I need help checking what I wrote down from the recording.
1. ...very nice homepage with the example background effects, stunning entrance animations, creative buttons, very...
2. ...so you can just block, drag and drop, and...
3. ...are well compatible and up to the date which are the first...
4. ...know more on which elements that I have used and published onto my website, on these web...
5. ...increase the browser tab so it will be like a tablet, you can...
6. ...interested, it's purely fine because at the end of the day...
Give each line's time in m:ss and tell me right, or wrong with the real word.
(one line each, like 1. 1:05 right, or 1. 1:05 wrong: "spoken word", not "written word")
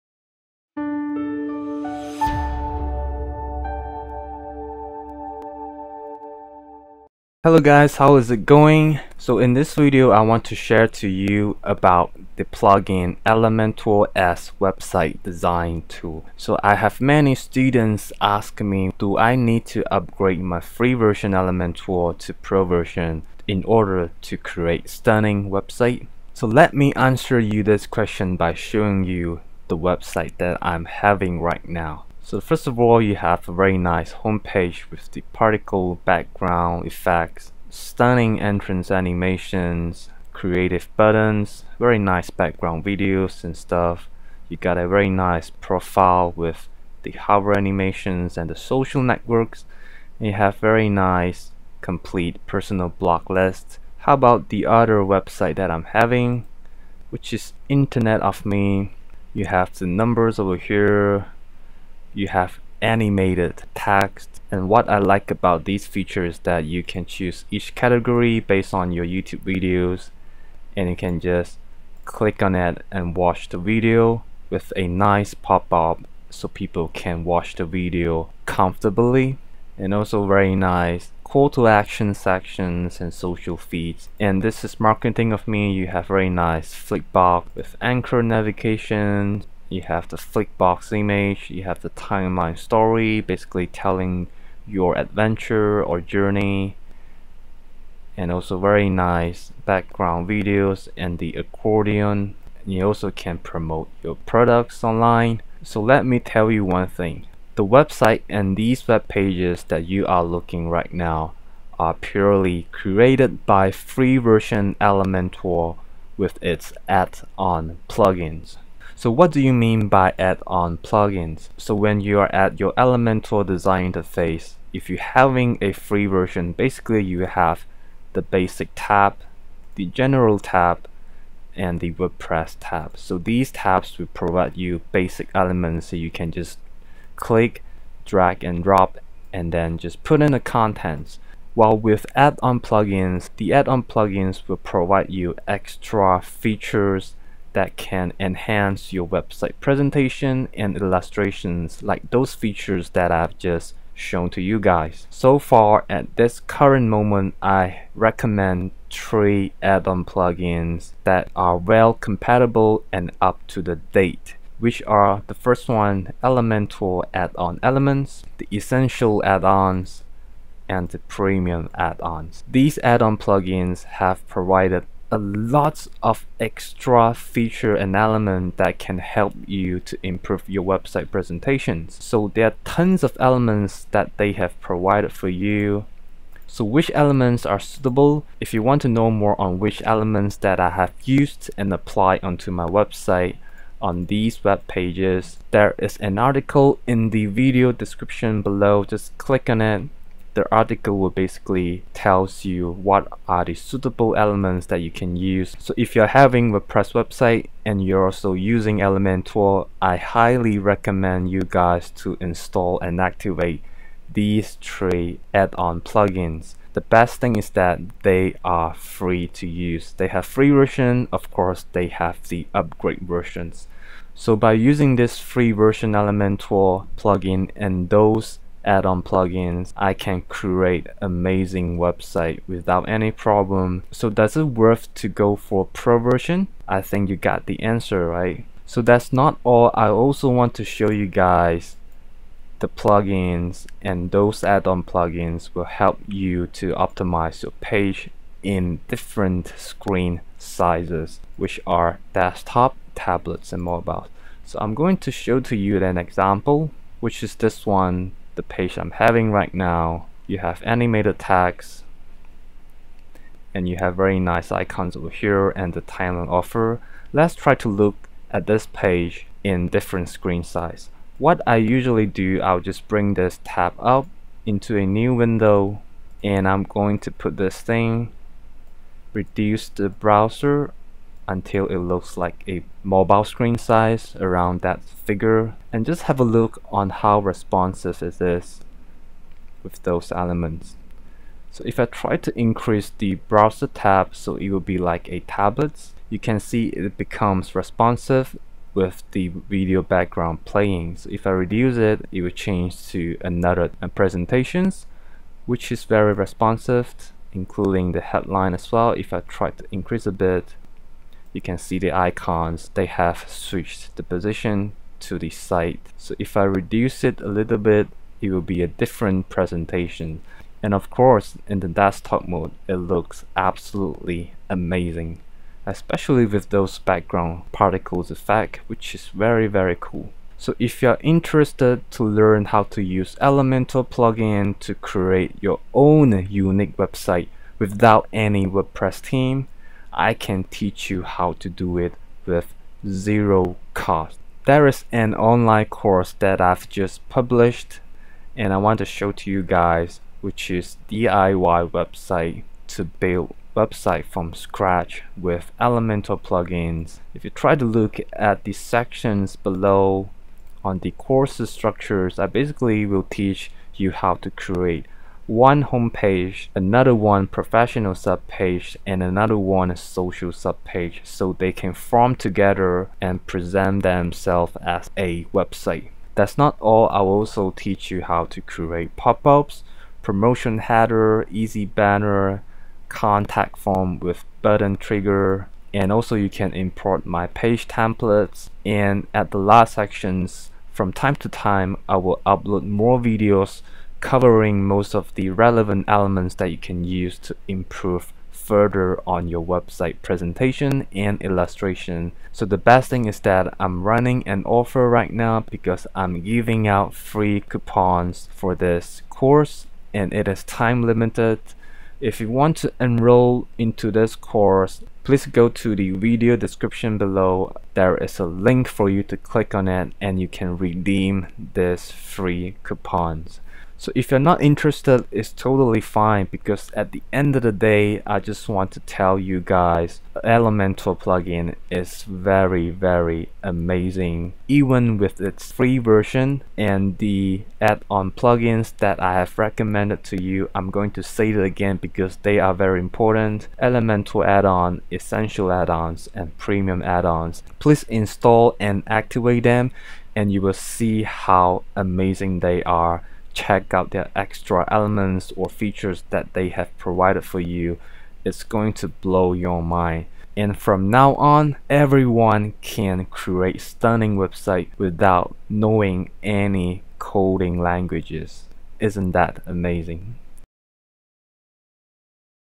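1. 0:33 wrong: "particle", not "example"
2. 2:15 wrong: "click", not "block"
3. 2:41 right
4. 3:08 wrong: "applied", not "published"
5. 4:52 right
6. 7:04 wrong: "totally", not "purely".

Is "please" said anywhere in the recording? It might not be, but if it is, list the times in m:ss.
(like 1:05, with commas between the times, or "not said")
6:55, 7:27.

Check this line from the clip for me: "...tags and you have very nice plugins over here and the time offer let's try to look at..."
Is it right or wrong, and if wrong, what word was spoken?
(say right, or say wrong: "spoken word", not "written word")
wrong: "icons", not "plugins".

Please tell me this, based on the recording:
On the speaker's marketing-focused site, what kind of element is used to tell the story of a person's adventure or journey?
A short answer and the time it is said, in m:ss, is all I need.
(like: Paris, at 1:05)
timeline story, at 1:31.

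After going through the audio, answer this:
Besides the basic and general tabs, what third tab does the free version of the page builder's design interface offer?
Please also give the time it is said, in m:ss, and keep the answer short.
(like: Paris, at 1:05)
WordPress tab, at 2:11.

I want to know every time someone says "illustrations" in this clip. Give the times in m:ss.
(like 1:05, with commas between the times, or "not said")
2:30, 6:41.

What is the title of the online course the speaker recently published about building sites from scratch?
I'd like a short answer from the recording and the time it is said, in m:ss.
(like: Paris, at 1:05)
DIY website, at 5:50.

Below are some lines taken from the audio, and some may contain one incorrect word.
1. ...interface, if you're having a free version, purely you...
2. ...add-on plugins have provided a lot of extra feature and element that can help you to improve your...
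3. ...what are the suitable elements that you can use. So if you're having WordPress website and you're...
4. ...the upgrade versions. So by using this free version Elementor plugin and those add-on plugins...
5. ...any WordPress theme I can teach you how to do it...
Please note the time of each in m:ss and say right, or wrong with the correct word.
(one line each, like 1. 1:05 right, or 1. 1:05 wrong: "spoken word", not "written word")
1. 2:03 wrong: "basically", not "purely"
2. 2:52 right
3. 3:22 right
4. 3:42 right
5. 5:38 right.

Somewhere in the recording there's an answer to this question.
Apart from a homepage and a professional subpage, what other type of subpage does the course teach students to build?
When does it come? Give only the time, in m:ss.
6:09.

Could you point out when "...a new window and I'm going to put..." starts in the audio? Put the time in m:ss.
4:34.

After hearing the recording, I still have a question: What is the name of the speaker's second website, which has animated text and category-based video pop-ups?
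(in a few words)
Internet of Me.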